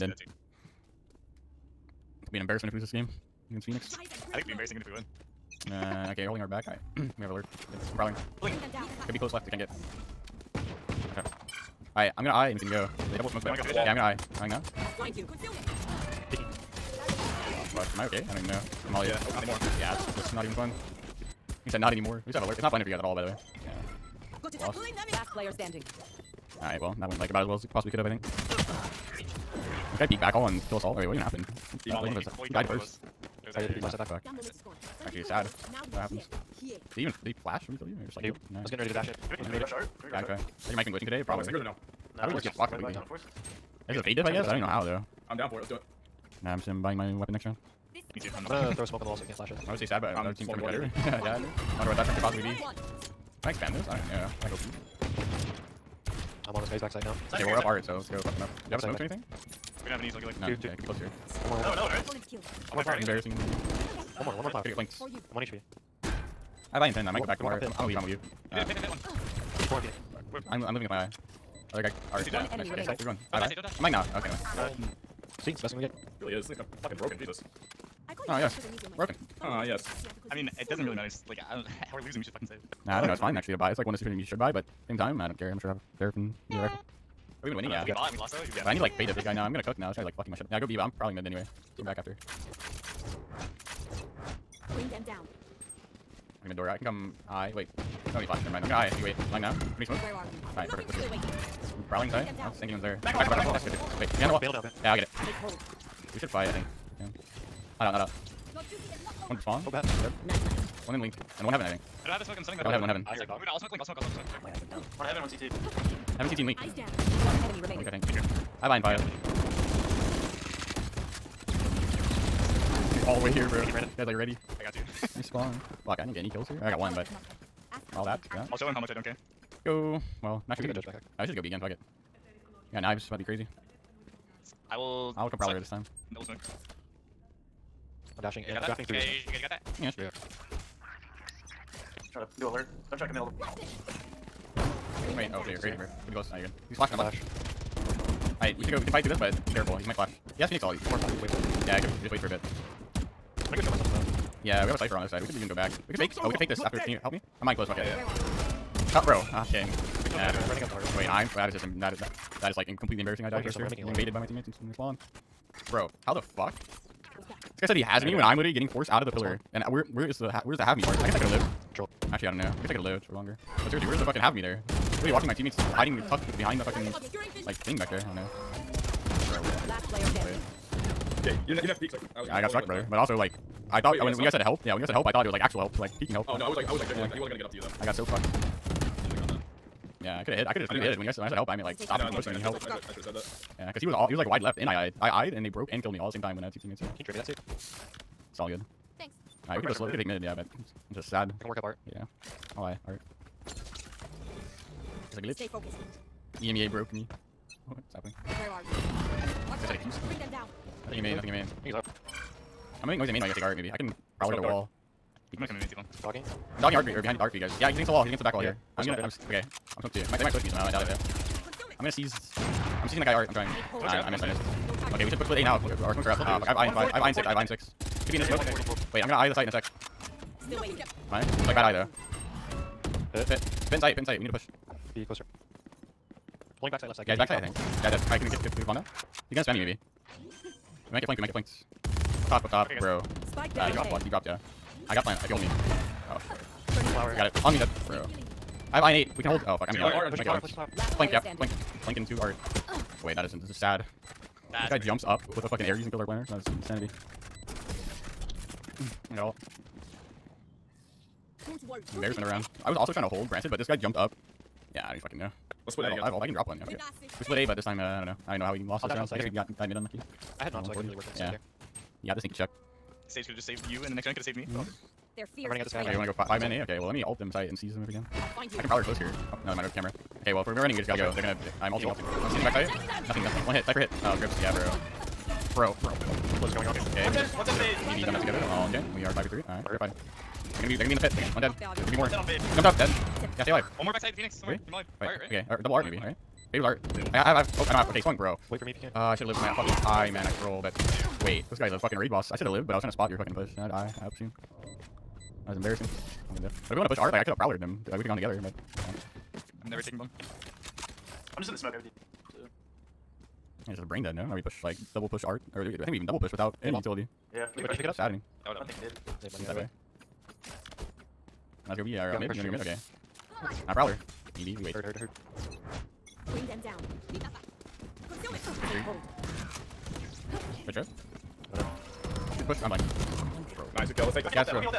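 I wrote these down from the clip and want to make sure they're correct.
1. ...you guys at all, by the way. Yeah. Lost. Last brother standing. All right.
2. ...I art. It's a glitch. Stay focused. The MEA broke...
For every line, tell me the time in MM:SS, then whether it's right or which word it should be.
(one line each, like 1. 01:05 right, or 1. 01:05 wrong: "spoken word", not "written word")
1. 00:22 wrong: "player", not "brother"
2. 03:22 right.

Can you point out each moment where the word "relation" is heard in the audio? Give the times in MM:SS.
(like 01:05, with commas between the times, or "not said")
not said.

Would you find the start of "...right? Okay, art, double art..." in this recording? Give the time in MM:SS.
04:55.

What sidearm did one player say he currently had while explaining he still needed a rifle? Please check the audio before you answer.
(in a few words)
Sheriff.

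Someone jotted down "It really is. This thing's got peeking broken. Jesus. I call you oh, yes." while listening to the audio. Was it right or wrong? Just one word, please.
wrong.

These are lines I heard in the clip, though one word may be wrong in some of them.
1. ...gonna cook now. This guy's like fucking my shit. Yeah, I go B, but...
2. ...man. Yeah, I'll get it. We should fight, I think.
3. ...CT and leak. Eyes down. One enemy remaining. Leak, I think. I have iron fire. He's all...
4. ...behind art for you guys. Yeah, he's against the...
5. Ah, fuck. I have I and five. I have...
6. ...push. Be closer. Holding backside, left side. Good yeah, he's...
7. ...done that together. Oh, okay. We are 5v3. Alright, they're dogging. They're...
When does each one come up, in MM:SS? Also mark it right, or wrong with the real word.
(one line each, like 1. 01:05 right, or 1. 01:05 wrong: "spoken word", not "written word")
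1. 01:29 right
2. 01:44 right
3. 01:56 right
4. 03:37 right
5. 03:46 right
6. 03:54 right
7. 04:48 wrong: "fighting", not "dogging".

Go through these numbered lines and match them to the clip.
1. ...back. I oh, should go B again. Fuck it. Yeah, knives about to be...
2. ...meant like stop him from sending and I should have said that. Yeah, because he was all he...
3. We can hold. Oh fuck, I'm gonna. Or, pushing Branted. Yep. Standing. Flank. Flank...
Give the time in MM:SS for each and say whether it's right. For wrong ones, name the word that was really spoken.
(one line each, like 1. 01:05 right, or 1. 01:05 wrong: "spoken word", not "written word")
1. 02:10 right
2. 03:11 wrong: "pushing", not "sending"
3. 04:09 wrong: "Flank", not "Branted".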